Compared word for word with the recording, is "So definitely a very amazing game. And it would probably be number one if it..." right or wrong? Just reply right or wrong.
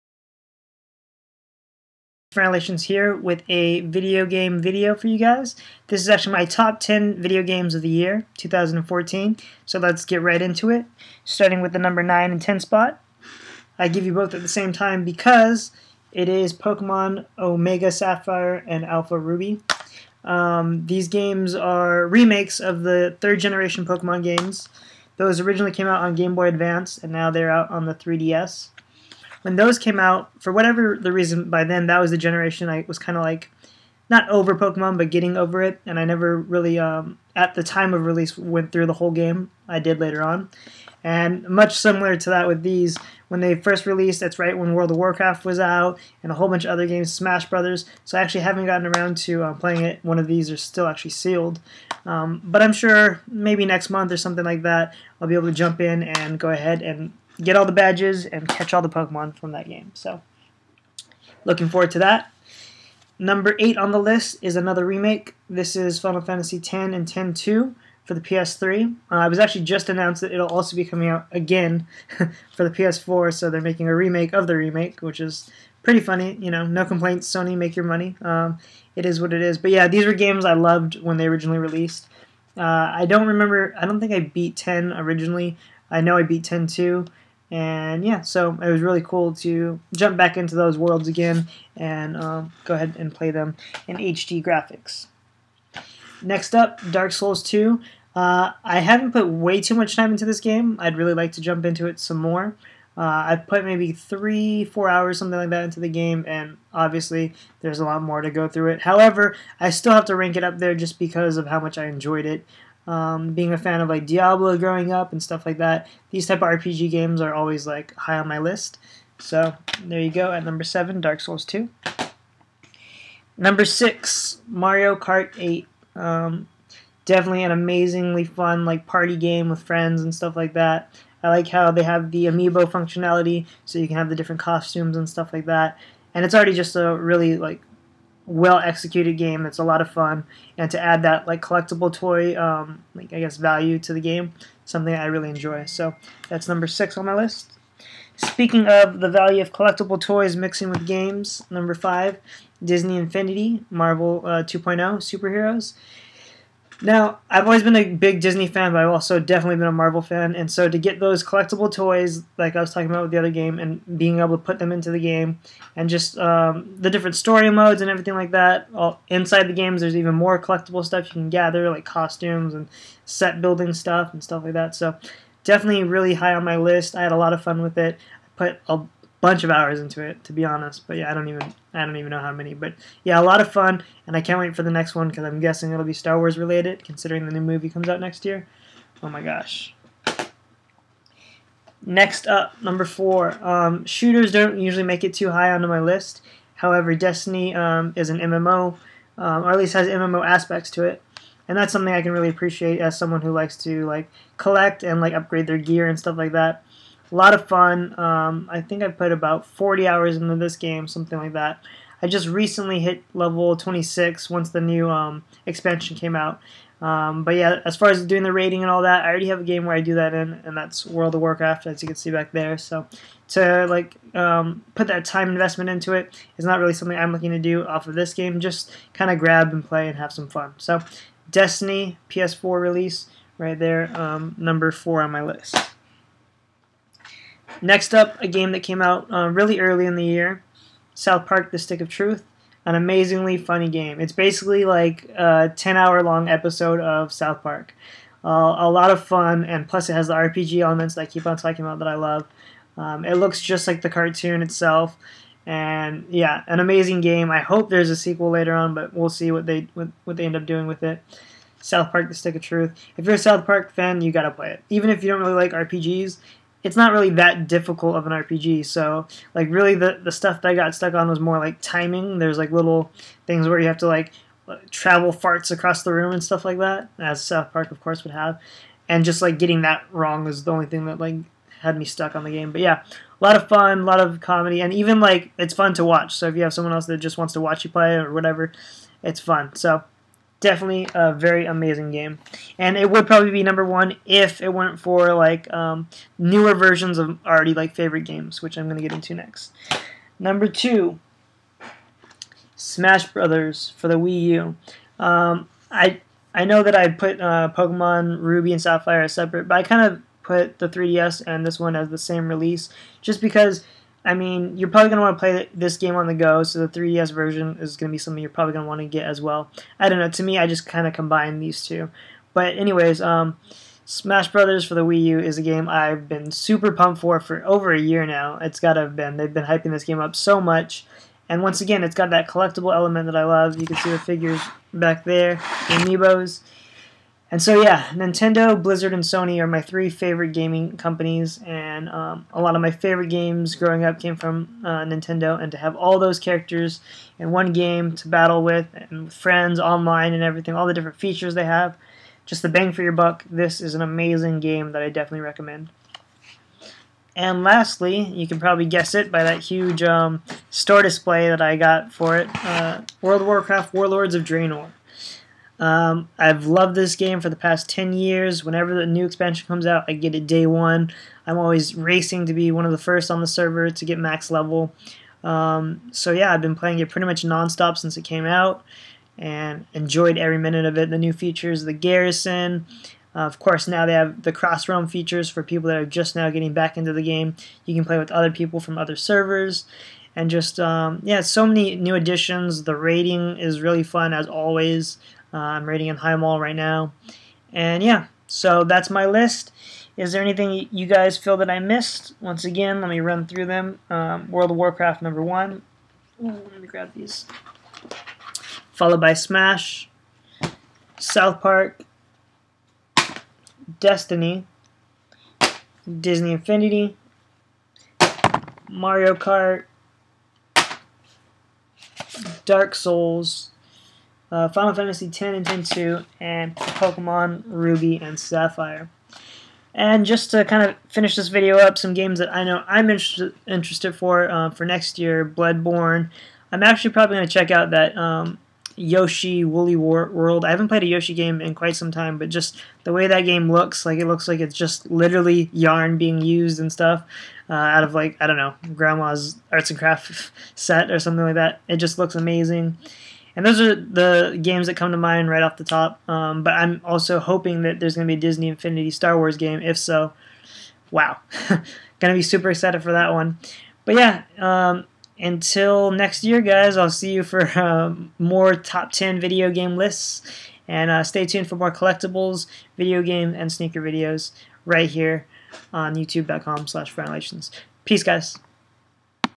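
right.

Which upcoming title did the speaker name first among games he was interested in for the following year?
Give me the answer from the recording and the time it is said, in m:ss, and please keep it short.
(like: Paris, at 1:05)
Bloodborne, at 7:15.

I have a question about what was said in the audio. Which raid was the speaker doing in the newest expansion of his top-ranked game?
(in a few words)
Highmaul.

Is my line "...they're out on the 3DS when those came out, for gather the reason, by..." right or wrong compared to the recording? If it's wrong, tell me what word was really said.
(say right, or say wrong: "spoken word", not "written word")
wrong: "whatever", not "gather".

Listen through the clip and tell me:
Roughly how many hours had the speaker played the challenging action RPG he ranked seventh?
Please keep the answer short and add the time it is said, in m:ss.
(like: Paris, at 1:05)
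3 to 4 hours, at 1:43.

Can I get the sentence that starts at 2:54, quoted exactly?
So definitely really high on my list.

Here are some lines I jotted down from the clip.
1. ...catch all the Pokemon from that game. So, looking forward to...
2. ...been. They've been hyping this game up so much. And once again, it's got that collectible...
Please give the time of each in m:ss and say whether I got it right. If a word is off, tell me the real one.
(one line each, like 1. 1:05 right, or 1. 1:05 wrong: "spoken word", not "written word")
1. 0:58 right
2. 5:28 right.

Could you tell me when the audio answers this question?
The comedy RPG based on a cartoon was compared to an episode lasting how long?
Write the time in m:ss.
4:05.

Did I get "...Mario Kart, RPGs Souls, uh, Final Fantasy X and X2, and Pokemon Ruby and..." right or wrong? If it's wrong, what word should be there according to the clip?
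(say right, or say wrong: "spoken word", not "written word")
wrong: "Dark", not "RPGs".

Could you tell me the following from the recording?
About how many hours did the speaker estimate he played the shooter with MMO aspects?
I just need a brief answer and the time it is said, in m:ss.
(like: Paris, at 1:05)
40, at 3:29.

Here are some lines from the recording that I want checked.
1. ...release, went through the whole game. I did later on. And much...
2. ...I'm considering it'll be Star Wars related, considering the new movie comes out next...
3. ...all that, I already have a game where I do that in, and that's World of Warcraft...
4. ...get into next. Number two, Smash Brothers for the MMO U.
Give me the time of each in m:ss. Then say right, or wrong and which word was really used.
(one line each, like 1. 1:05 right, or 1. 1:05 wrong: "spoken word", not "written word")
1. 0:38 right
2. 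3:05 wrong: "guessing", not "considering"
3. 3:38 right
4. 4:58 wrong: "Wii", not "MMO".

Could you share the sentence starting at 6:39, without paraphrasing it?
Is there anything you guys feel that I missed?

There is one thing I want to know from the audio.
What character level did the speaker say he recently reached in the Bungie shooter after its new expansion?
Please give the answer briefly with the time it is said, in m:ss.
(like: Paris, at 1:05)
26, at 3:33.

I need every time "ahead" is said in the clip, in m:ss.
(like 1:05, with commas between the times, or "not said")
0:56, 1:32.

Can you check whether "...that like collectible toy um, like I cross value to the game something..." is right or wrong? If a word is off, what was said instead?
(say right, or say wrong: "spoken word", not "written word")
wrong: "guess", not "cross".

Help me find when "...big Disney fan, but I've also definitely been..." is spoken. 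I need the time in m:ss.
2:37.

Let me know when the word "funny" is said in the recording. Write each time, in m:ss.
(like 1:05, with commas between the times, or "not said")
1:15, 4:03.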